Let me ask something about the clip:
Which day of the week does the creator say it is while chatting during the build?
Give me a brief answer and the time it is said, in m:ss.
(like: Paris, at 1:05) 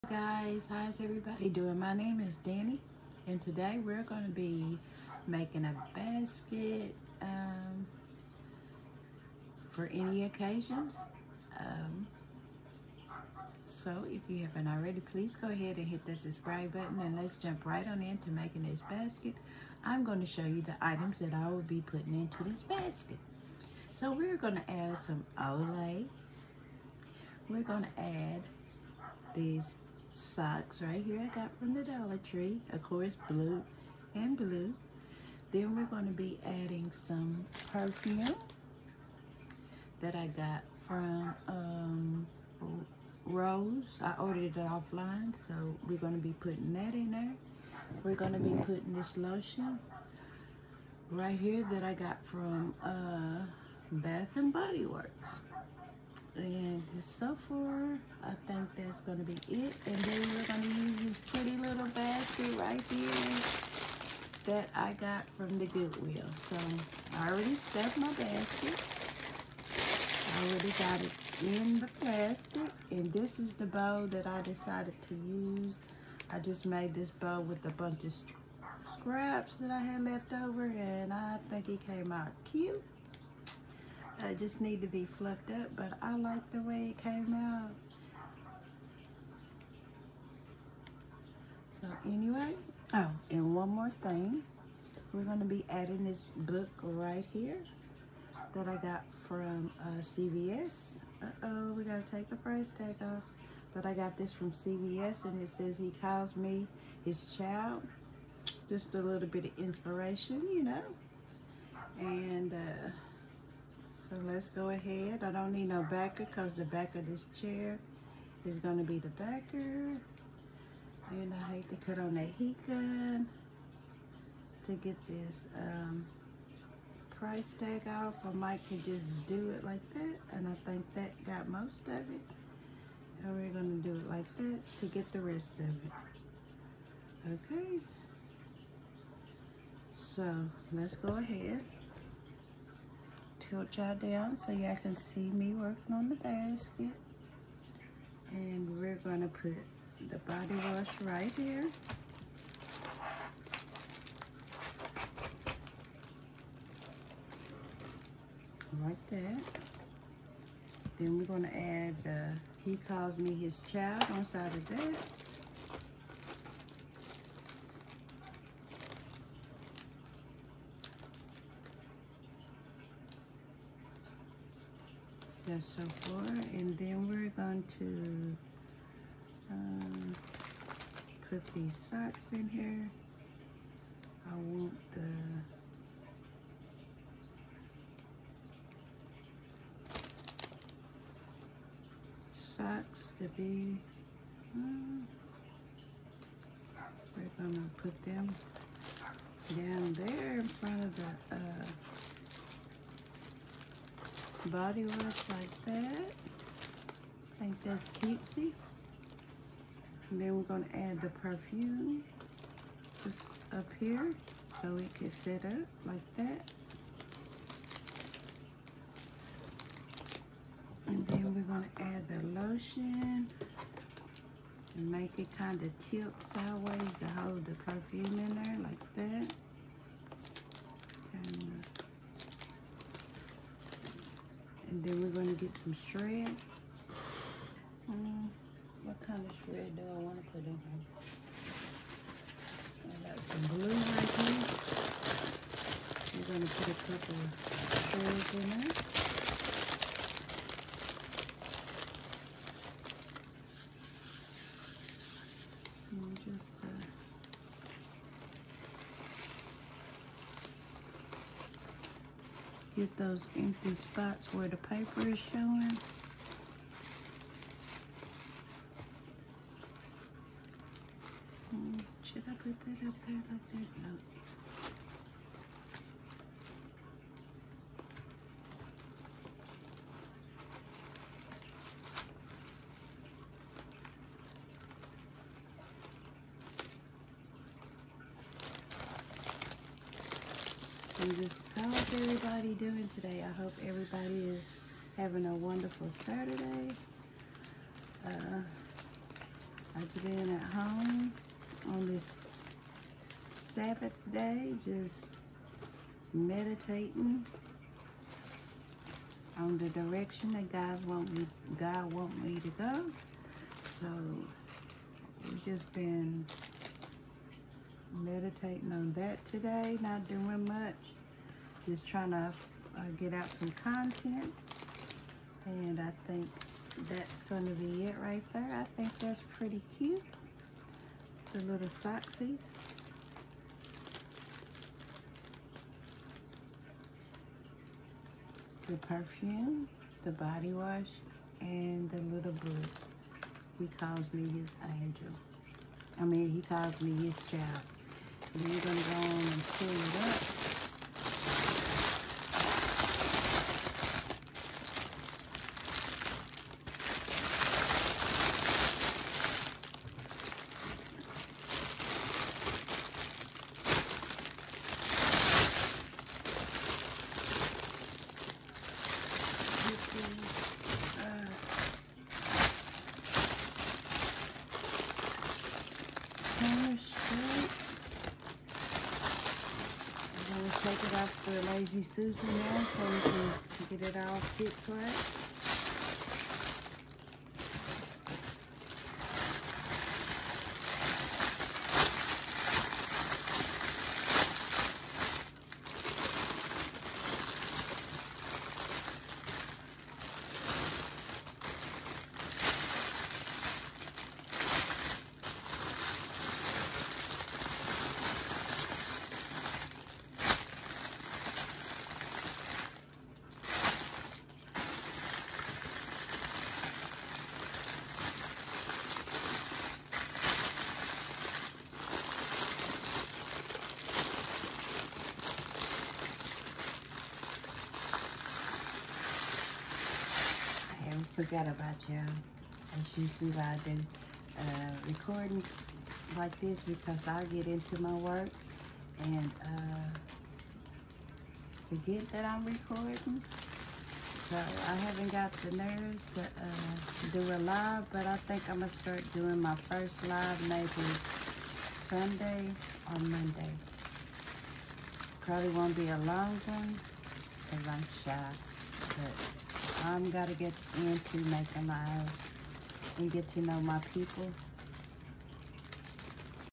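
Saturday, at 4:56.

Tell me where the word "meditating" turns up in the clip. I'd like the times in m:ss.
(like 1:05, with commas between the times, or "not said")
5:06, 5:17.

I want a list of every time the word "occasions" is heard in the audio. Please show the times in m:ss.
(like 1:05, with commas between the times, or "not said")
0:10.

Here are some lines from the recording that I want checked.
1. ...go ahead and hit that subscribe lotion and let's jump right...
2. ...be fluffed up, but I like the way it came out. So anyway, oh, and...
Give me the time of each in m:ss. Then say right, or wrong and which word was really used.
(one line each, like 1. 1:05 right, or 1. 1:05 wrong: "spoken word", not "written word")
1. 0:15 wrong: "button", not "lotion"
2. 1:24 right.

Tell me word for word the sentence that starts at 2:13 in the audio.
And we're going to do it like that to get the rest of it.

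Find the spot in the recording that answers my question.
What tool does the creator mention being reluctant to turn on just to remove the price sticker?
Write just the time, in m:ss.
2:02.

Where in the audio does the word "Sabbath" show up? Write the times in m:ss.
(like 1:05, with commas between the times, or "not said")
5:03.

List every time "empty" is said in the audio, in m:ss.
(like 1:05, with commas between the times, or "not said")
4:23.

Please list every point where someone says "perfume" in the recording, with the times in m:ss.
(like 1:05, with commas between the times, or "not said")
0:37, 3:31, 3:47, 5:38.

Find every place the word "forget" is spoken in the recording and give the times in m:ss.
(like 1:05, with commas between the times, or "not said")
7:11, 7:21.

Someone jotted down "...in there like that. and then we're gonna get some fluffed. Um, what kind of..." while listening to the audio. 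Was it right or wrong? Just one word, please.
wrong.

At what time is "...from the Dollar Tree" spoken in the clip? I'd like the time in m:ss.
0:31.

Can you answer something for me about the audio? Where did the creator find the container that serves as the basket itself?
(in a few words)
Goodwill.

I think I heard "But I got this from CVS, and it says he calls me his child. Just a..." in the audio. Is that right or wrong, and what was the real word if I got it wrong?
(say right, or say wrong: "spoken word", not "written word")
right.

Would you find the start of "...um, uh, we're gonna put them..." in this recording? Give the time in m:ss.
3:14.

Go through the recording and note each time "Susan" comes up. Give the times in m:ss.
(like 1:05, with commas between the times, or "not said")
6:21.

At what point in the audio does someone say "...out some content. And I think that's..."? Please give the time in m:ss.
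5:23.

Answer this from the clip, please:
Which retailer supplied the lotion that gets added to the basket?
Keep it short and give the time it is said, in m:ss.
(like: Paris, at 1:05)
Bath and Body Works, at 0:53.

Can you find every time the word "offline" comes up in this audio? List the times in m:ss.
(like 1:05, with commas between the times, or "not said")
0:44.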